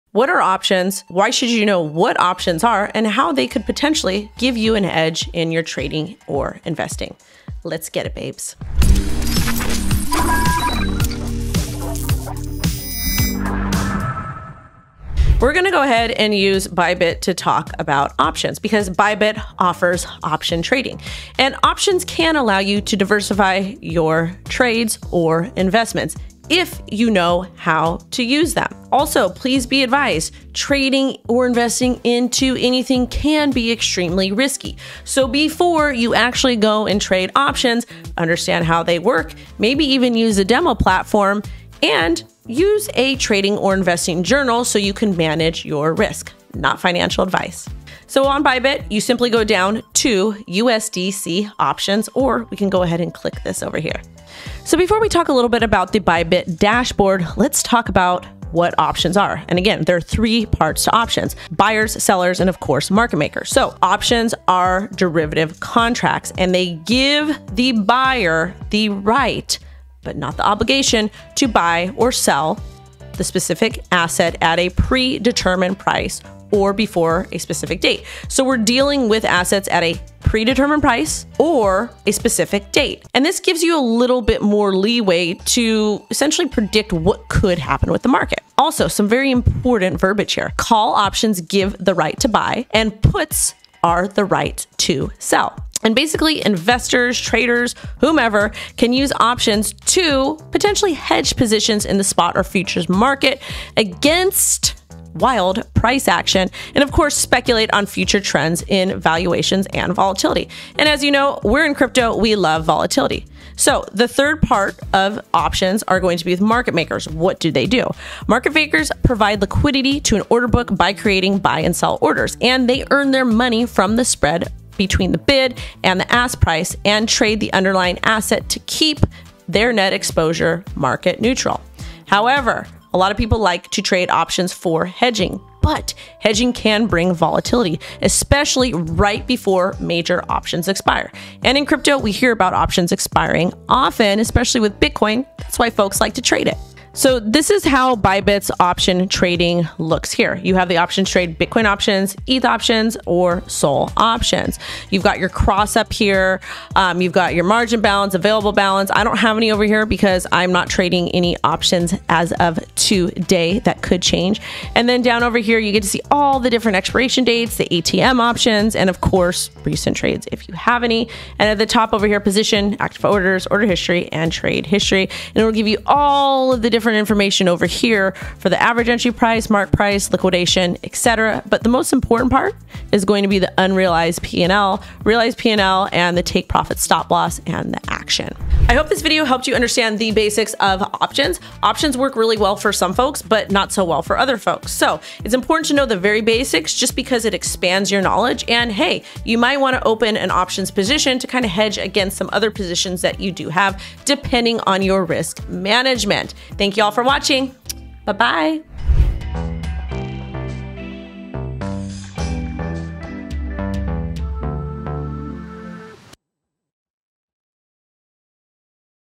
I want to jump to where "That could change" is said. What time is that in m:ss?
2:43.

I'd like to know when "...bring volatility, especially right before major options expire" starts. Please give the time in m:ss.
2:16.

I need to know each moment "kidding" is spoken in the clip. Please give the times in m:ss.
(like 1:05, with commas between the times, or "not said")
not said.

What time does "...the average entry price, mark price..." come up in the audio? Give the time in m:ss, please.
2:58.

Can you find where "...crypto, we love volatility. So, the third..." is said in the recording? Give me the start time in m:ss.
1:51.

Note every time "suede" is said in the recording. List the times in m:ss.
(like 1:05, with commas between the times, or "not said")
not said.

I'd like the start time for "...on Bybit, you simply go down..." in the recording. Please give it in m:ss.
0:48.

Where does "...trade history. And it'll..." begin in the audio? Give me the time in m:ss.
2:54.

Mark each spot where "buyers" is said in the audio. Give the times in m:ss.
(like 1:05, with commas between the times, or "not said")
1:01, 1:07.